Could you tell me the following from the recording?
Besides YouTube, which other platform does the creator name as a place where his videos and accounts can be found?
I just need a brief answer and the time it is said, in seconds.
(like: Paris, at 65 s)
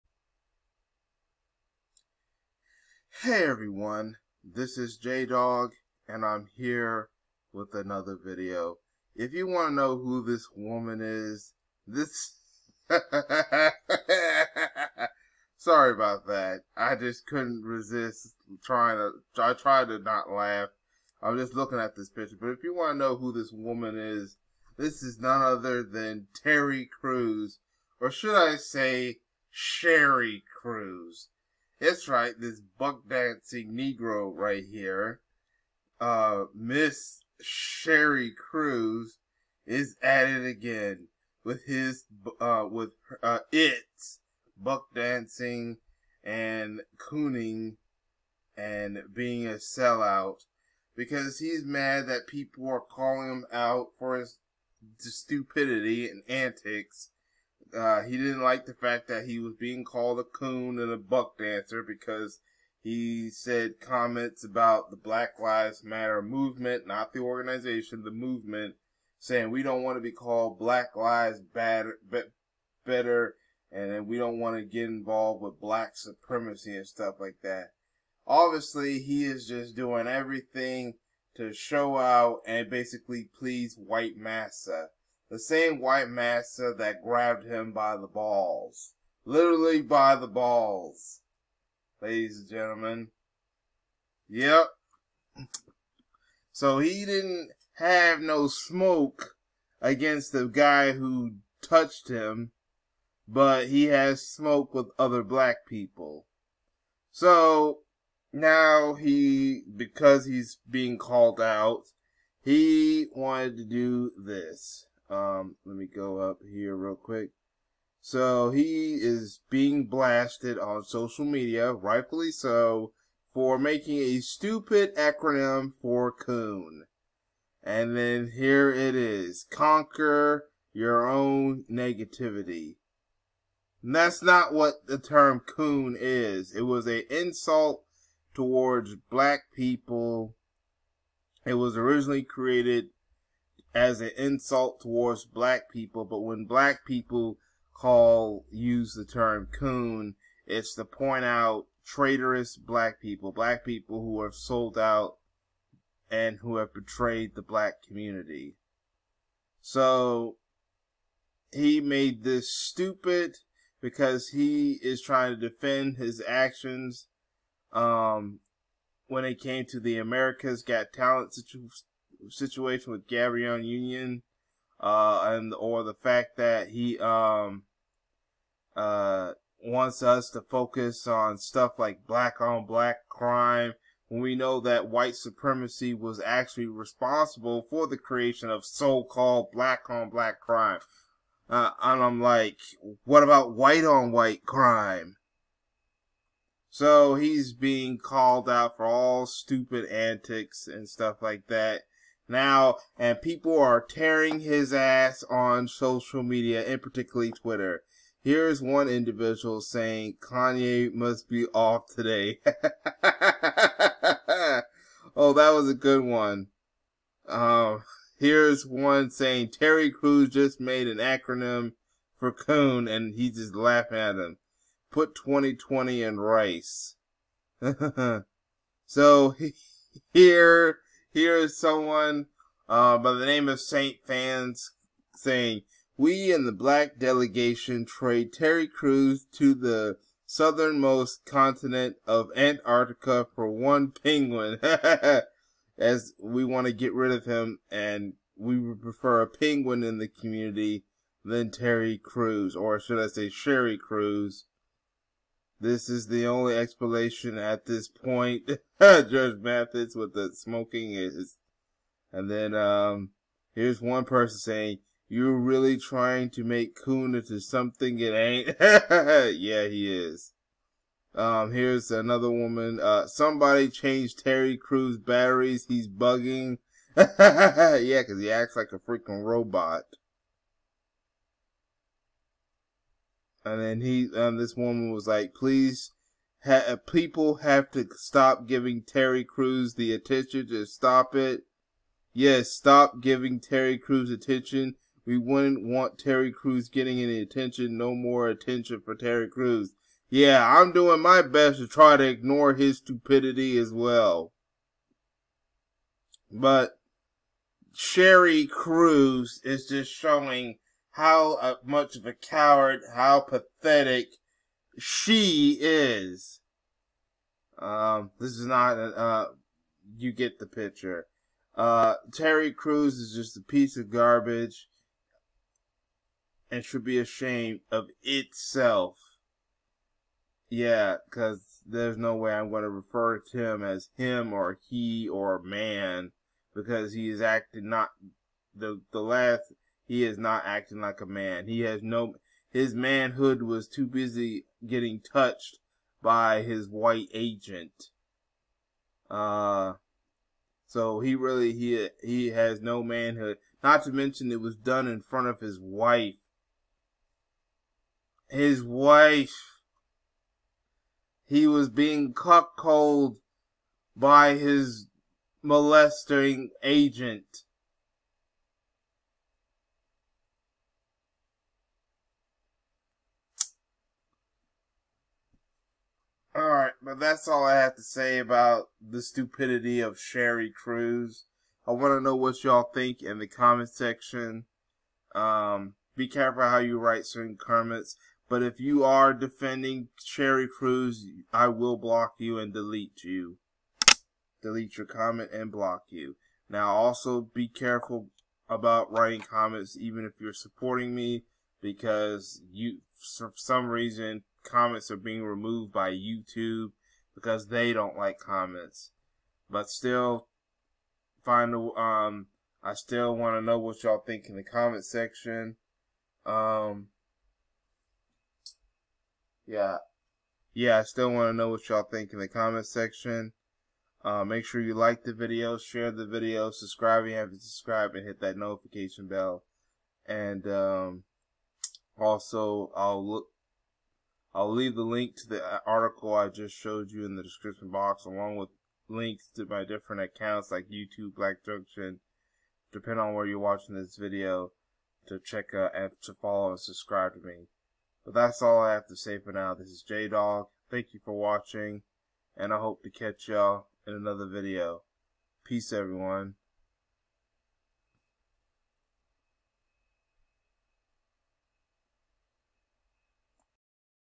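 Black Junction, at 441 s.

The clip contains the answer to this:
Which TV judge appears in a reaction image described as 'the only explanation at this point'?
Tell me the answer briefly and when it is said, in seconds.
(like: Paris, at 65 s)
Judge Mathis, at 258 s.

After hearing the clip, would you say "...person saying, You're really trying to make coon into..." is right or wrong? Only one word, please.
right.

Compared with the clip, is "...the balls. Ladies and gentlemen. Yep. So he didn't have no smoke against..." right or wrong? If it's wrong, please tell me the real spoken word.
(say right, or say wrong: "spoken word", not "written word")
right.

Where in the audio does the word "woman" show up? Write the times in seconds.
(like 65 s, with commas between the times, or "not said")
10 s, 23 s, 272 s, 284 s.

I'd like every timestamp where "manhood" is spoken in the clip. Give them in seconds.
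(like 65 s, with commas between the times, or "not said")
342 s, 352 s.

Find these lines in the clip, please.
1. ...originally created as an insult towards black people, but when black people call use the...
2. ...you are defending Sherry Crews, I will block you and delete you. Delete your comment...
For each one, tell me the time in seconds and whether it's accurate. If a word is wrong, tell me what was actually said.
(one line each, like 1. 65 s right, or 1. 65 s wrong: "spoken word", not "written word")
1. 141 s right
2. 388 s right.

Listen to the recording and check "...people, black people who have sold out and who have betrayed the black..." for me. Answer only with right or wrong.
right.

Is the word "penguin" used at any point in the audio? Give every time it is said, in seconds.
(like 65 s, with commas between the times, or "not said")
243 s, 249 s.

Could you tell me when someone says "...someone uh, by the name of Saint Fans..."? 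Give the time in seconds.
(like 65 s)
231 s.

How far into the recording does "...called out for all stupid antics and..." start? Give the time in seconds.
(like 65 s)
197 s.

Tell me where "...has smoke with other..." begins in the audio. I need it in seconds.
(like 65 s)
103 s.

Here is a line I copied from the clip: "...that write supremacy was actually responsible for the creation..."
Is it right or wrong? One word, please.
wrong.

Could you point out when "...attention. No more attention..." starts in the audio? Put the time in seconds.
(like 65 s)
297 s.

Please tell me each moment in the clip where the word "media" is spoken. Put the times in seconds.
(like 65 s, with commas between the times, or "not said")
121 s, 206 s.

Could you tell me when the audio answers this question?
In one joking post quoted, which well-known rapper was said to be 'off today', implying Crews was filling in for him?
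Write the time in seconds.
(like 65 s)
210 s.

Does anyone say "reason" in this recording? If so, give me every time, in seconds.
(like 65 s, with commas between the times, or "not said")
403 s.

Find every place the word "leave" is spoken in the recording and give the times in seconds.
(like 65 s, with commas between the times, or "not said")
434 s.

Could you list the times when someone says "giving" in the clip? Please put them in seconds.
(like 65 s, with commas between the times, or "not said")
288 s, 292 s.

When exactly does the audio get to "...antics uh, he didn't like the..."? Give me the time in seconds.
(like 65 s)
56 s.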